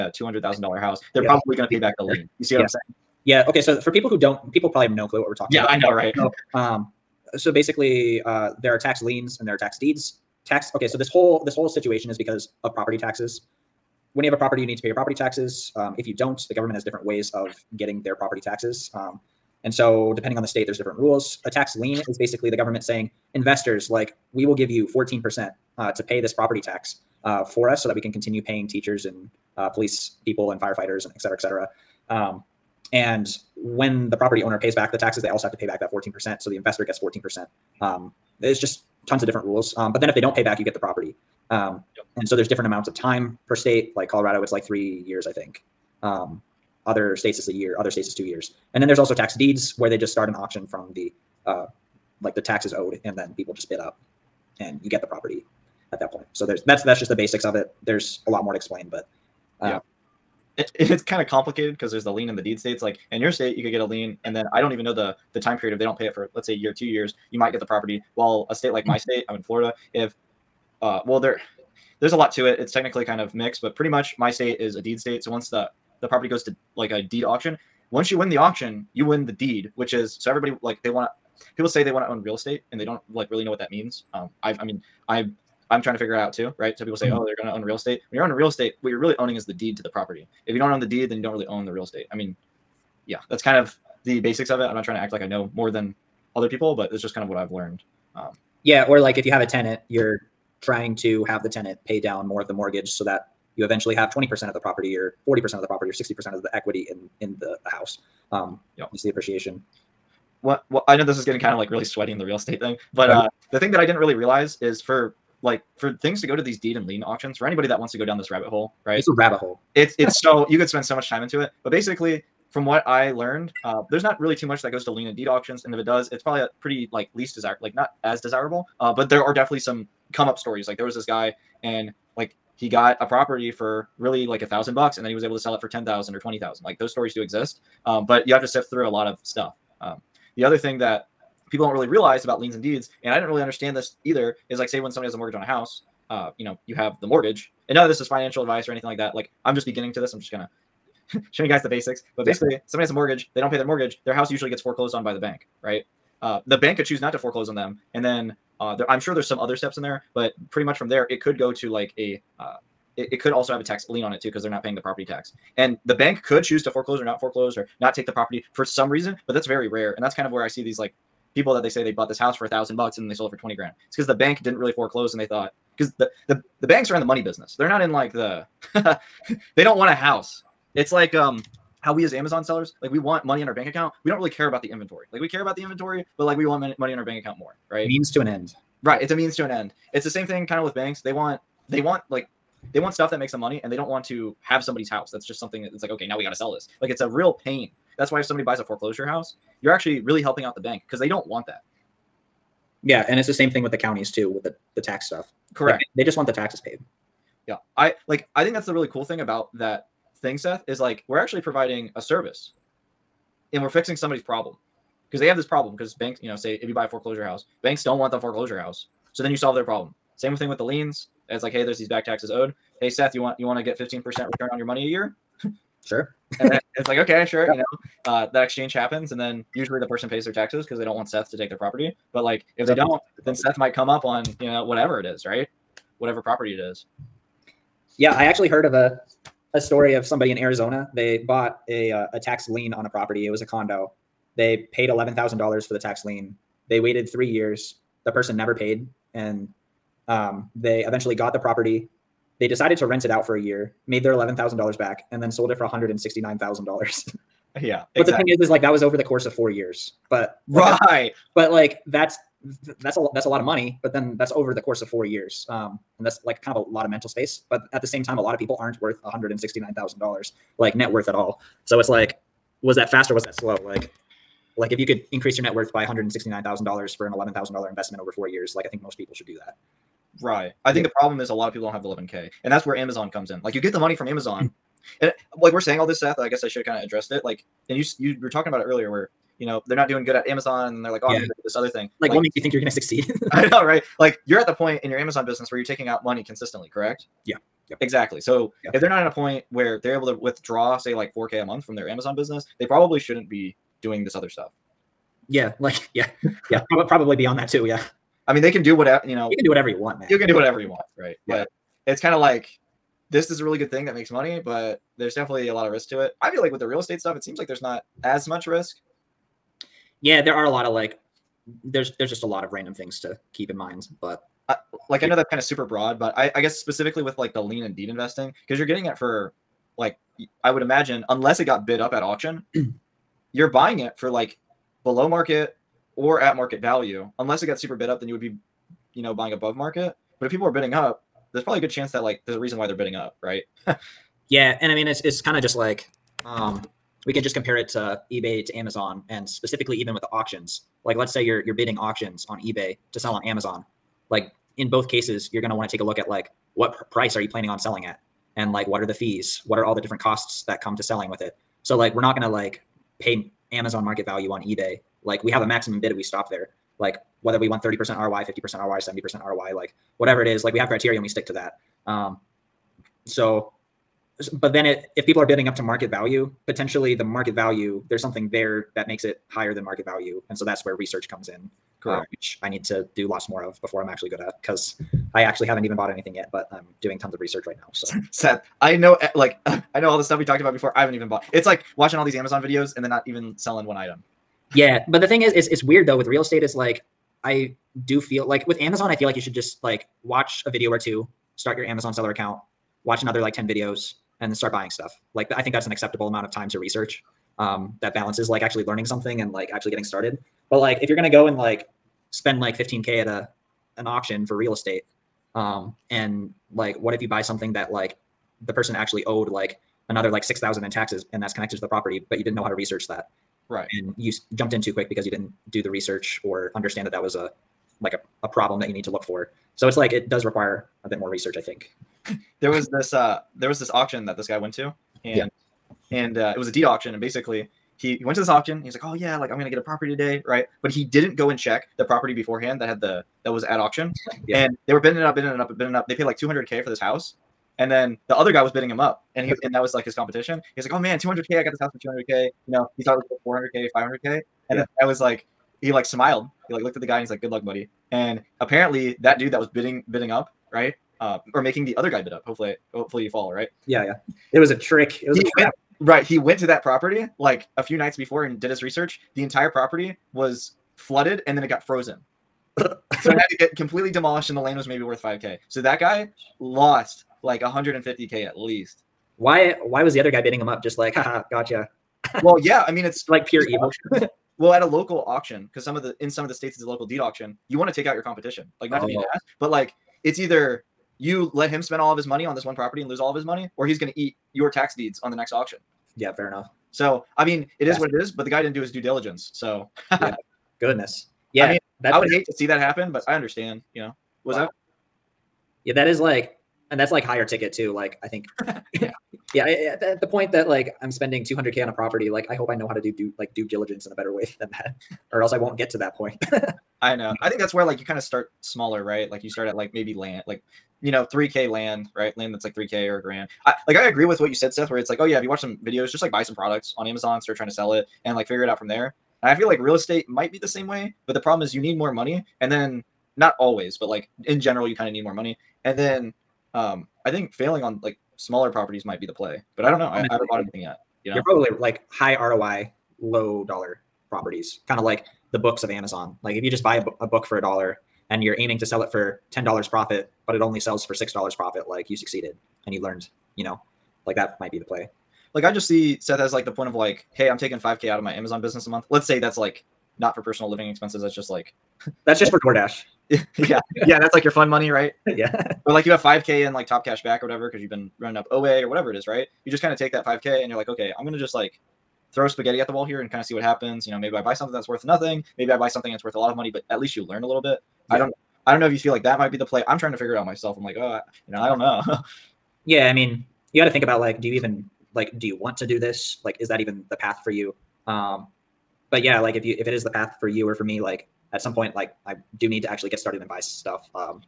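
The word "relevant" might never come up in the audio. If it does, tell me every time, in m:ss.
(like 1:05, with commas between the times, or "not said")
not said.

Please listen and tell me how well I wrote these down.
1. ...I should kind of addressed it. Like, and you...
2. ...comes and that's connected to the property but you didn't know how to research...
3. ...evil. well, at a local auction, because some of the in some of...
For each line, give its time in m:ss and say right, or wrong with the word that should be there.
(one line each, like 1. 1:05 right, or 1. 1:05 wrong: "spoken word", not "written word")
1. 4:46 right
2. 7:00 wrong: "taxes", not "comes"
3. 8:03 right.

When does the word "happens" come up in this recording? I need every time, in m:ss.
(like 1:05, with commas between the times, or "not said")
3:48, 8:22, 9:33.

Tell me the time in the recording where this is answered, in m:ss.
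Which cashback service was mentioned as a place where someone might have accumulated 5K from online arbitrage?
9:26.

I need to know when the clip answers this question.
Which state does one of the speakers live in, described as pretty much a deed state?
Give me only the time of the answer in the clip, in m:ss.
1:09.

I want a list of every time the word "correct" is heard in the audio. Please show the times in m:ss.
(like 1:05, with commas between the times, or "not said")
3:25, 4:56, 6:21.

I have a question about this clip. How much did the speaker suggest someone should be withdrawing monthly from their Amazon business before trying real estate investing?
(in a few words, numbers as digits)
4K a month.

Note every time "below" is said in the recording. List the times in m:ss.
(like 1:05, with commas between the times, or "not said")
5:34.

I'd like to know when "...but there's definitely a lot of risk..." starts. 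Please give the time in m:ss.
5:14.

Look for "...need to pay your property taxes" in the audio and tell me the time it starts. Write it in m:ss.
0:14.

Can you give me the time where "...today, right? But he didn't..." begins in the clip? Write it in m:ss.
7:19.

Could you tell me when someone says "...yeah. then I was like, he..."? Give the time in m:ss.
7:34.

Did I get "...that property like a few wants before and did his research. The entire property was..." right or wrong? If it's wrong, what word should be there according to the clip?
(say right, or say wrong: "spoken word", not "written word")
wrong: "nights", not "wants".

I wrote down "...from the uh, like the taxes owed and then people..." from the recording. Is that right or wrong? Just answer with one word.
right.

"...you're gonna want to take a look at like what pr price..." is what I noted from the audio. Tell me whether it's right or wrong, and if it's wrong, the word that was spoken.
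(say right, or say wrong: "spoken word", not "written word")
right.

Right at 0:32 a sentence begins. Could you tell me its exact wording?
Um, and when the property owner pays back the taxes, they also have to pay back that 14%.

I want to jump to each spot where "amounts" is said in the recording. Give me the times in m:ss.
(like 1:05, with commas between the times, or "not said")
0:42, 6:46.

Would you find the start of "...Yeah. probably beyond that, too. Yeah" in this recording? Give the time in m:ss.
5:06.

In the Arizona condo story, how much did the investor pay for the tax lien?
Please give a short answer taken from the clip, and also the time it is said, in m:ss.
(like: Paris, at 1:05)
$11,000, at 4:04.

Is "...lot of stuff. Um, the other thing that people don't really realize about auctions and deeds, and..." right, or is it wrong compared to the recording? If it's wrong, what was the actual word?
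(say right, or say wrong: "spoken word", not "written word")
wrong: "liens", not "auctions".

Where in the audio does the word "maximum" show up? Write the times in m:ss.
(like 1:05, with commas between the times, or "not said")
6:05.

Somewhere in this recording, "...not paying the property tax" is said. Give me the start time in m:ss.
2:44.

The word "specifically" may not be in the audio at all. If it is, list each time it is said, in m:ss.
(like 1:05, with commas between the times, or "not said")
5:26, 5:49.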